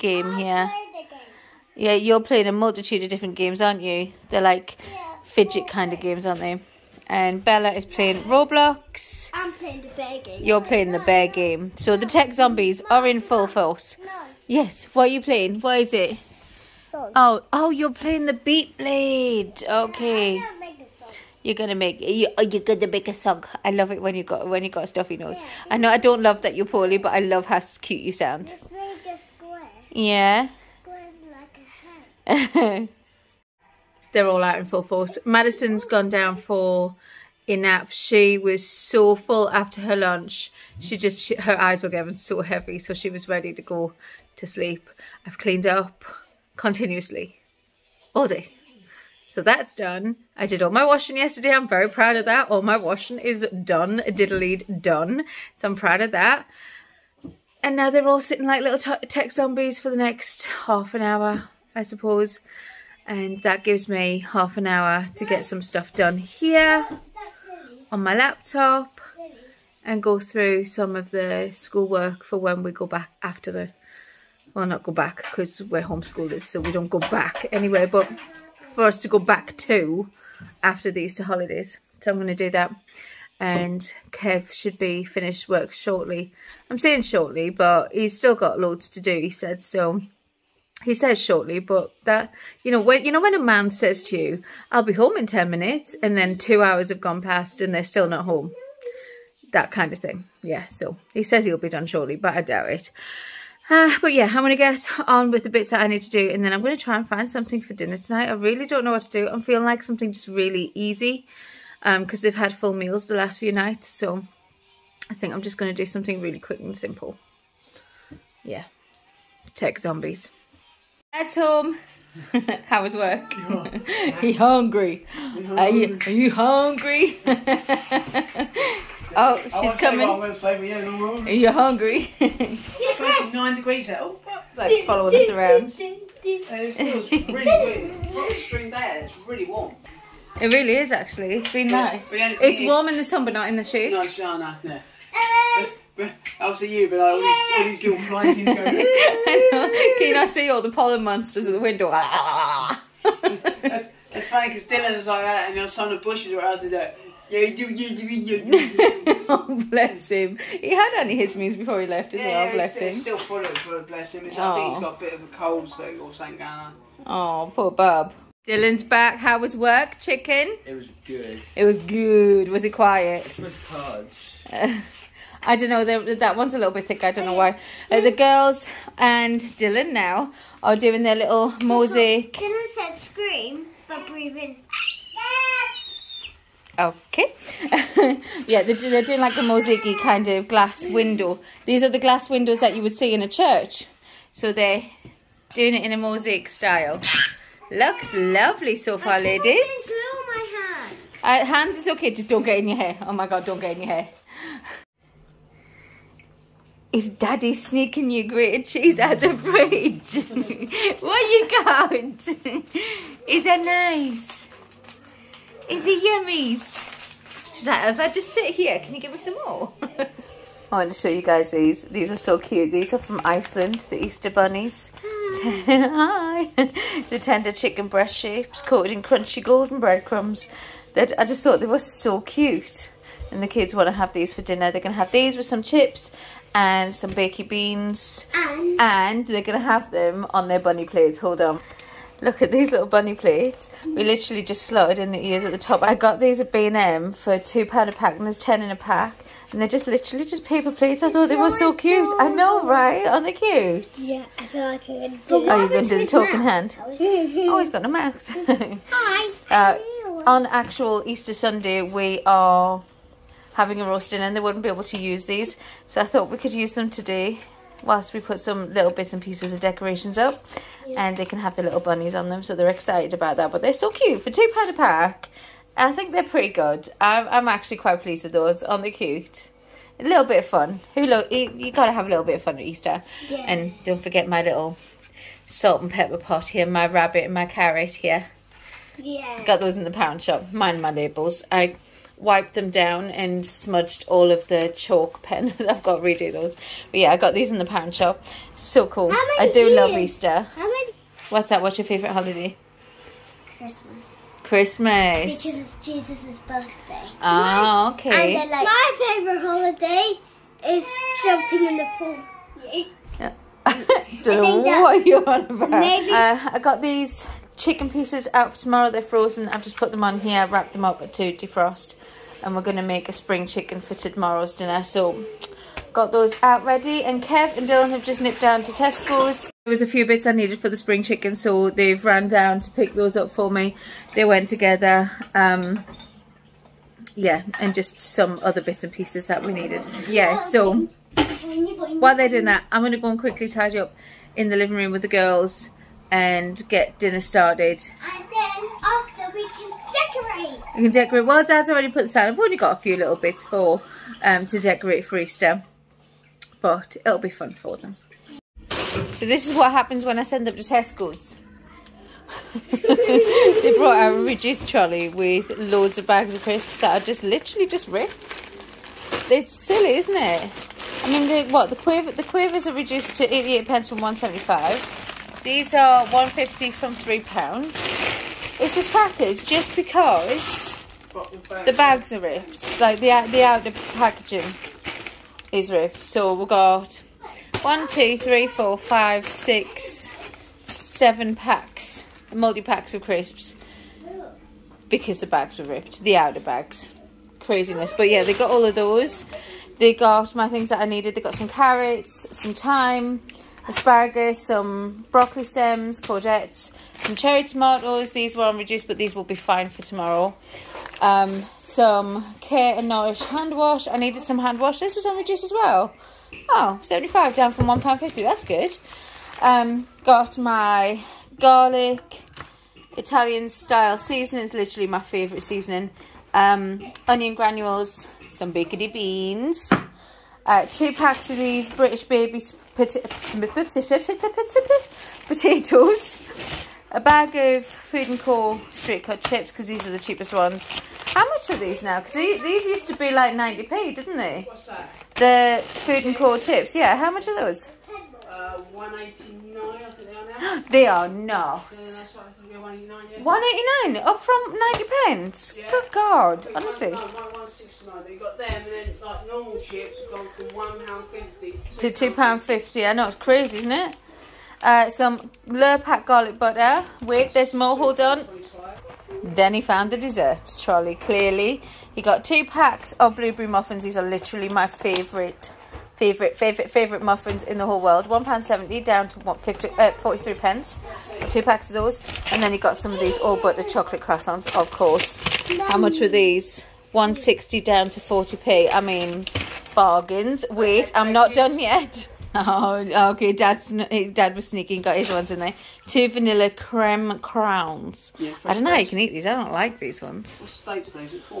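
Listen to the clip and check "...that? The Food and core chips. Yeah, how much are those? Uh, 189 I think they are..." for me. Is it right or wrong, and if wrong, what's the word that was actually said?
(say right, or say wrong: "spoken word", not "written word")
right.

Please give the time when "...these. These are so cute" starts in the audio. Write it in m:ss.
3:41.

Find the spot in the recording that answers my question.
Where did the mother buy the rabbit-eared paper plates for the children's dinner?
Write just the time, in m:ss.
4:06.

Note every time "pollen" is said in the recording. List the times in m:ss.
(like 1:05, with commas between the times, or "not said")
2:30.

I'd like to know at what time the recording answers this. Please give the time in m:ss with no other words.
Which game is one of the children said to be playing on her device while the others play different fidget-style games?
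0:08.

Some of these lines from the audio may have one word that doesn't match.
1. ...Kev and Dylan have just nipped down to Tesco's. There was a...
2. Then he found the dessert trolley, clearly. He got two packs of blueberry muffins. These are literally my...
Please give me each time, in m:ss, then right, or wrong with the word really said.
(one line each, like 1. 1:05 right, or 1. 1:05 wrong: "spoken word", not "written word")
1. 5:27 right
2. 7:49 right.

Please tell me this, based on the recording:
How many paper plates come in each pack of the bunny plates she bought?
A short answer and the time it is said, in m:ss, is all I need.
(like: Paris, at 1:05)
10, at 4:08.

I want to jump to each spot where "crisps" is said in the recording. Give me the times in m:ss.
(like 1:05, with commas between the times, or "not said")
6:06, 6:33.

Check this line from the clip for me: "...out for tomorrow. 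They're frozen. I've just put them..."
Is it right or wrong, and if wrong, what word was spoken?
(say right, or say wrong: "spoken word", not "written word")
right.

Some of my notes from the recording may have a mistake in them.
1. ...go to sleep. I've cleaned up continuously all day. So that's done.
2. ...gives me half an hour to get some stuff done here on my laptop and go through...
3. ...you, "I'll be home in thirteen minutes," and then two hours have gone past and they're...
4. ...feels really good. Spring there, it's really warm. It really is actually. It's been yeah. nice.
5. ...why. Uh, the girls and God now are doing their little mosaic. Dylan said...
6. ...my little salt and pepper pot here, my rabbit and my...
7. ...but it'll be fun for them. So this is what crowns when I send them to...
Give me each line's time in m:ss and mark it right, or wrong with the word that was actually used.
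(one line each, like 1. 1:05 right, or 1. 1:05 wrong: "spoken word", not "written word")
1. 0:43 right
2. 1:03 right
3. 1:34 wrong: "ten", not "thirteen"
4. 2:16 right
5. 2:57 wrong: "Dylan", not "God"
6. 4:44 right
7. 5:56 wrong: "happens", not "crowns".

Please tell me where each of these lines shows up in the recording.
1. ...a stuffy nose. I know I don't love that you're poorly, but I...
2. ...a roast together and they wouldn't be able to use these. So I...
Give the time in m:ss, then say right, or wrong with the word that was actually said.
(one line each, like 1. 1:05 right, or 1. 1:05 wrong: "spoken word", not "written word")
1. 0:24 right
2. 4:23 wrong: "dinner", not "together".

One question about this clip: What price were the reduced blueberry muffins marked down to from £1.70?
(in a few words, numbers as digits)
43p.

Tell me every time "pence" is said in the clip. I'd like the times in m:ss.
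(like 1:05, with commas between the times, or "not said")
6:13, 7:35, 8:00.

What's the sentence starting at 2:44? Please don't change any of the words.
got a bit of a cold so, or something going on.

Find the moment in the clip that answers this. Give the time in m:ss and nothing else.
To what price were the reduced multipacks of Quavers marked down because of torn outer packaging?
6:13.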